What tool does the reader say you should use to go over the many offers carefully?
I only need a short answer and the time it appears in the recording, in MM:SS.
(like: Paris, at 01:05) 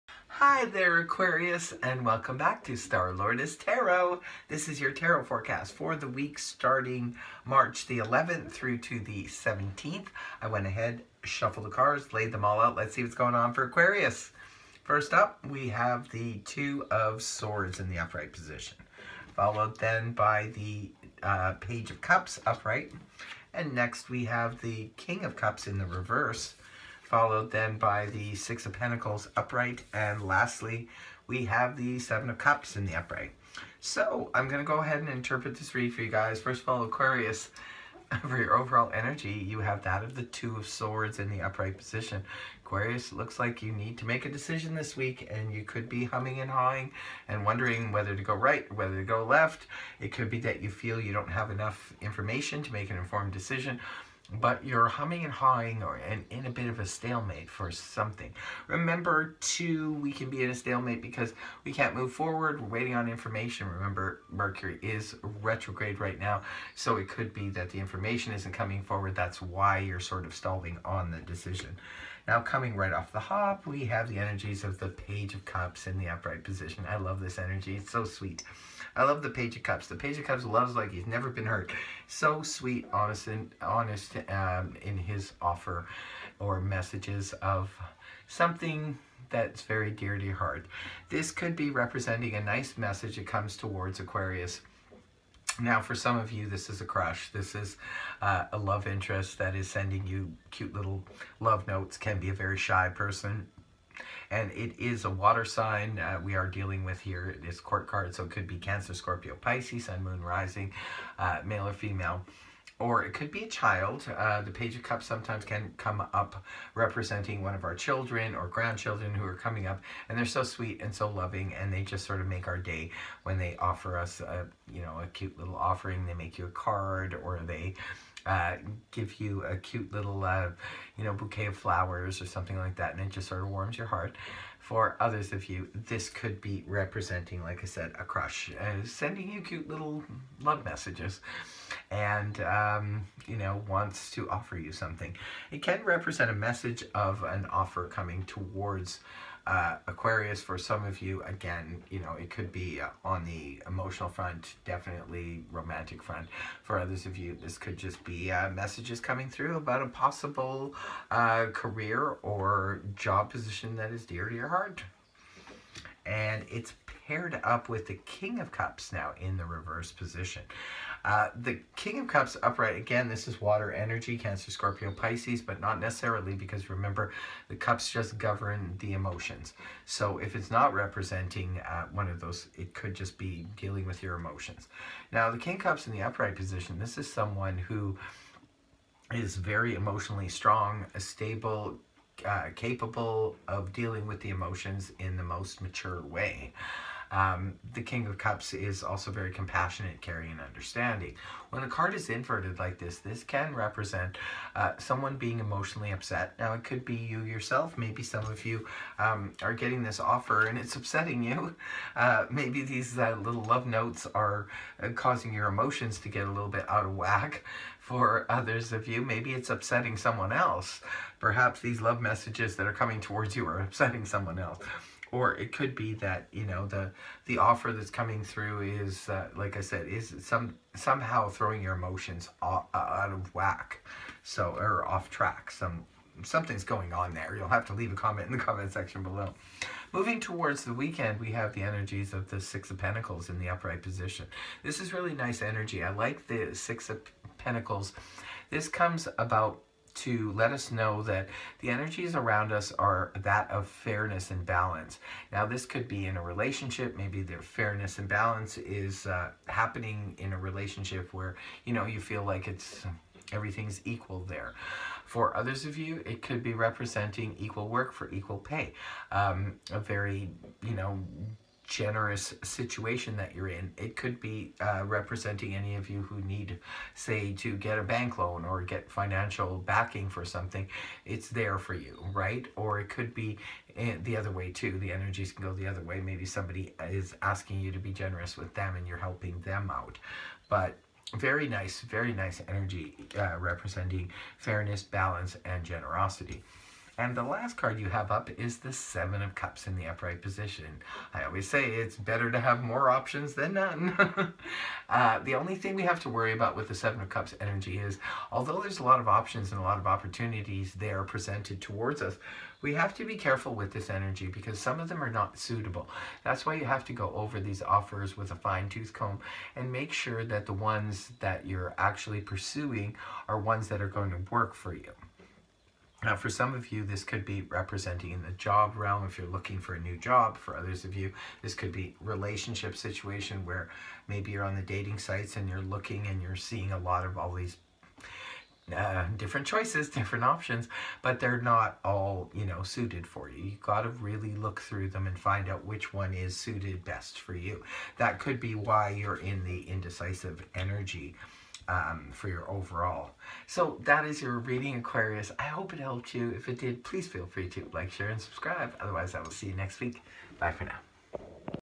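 fine tooth comb, at 05:18.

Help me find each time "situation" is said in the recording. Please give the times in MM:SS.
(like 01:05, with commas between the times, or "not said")
04:32, 05:32.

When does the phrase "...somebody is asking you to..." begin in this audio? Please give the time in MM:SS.
04:46.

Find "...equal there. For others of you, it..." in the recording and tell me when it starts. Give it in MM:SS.
04:23.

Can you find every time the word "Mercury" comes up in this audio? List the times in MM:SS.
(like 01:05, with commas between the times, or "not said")
01:04.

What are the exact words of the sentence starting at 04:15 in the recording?
Now, this could be in a relationship.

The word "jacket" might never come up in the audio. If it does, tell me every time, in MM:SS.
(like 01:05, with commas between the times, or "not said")
not said.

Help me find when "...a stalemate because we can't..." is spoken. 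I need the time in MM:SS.
01:00.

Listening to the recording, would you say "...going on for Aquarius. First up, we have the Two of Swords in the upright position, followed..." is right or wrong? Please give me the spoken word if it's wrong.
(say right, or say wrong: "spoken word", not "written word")
right.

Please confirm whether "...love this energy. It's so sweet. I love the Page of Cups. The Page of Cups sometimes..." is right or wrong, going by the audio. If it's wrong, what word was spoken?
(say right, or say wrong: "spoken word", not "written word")
wrong: "loves", not "sometimes".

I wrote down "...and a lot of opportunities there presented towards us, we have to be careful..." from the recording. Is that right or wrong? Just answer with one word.
right.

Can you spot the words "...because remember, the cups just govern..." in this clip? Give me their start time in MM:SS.
02:56.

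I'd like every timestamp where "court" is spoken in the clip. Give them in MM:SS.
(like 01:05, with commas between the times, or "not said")
01:47.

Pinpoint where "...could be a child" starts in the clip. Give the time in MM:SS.
01:53.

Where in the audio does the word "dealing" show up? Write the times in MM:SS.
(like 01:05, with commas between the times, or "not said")
01:46, 03:03, 03:13.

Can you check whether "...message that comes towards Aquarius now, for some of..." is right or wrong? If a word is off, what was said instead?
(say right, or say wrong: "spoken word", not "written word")
right.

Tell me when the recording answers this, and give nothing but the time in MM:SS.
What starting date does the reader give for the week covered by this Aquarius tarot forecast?
00:07.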